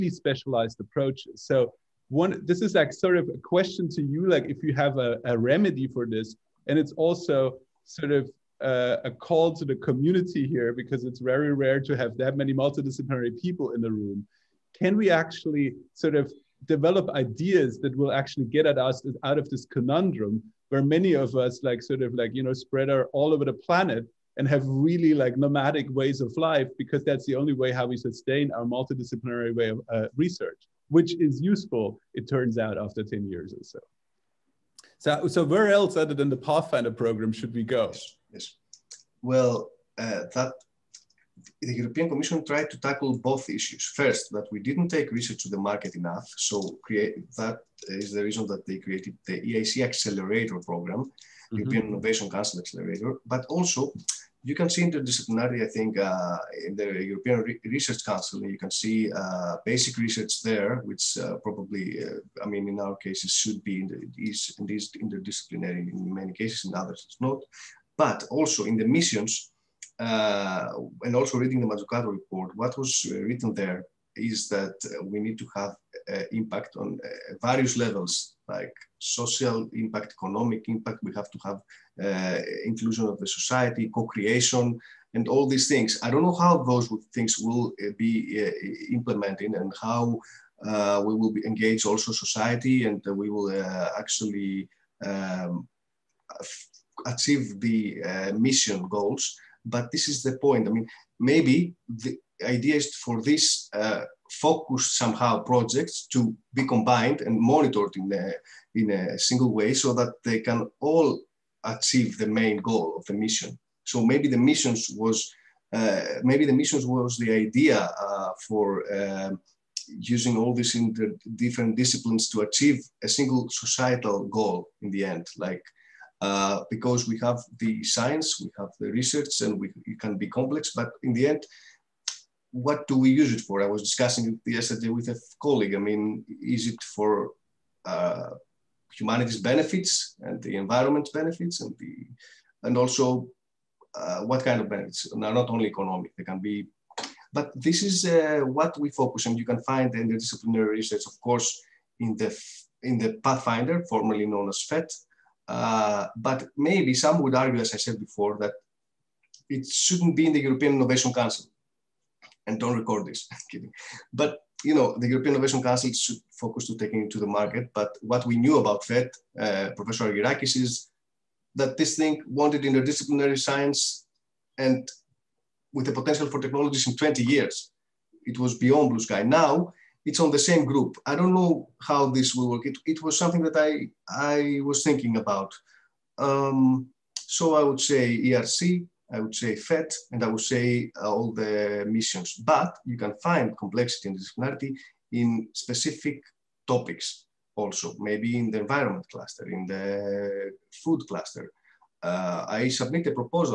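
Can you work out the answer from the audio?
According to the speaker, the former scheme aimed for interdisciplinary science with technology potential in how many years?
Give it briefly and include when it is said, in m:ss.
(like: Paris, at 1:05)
20 years, at 2:56.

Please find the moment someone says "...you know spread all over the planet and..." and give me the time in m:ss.
0:22.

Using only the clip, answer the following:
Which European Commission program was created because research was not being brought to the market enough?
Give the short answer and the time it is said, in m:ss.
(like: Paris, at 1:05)
EIC Accelerator Program, at 0:49.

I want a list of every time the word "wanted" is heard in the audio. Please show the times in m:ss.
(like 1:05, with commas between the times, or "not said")
2:52.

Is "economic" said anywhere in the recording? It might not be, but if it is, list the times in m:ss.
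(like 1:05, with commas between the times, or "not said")
1:20, 2:25.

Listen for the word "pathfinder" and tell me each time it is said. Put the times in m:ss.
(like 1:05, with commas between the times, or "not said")
0:36, 2:33.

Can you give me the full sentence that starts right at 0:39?
Well, uh, that the European Commission tried to tackle both issues.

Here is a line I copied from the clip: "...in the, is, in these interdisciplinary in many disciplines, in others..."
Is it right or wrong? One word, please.
wrong.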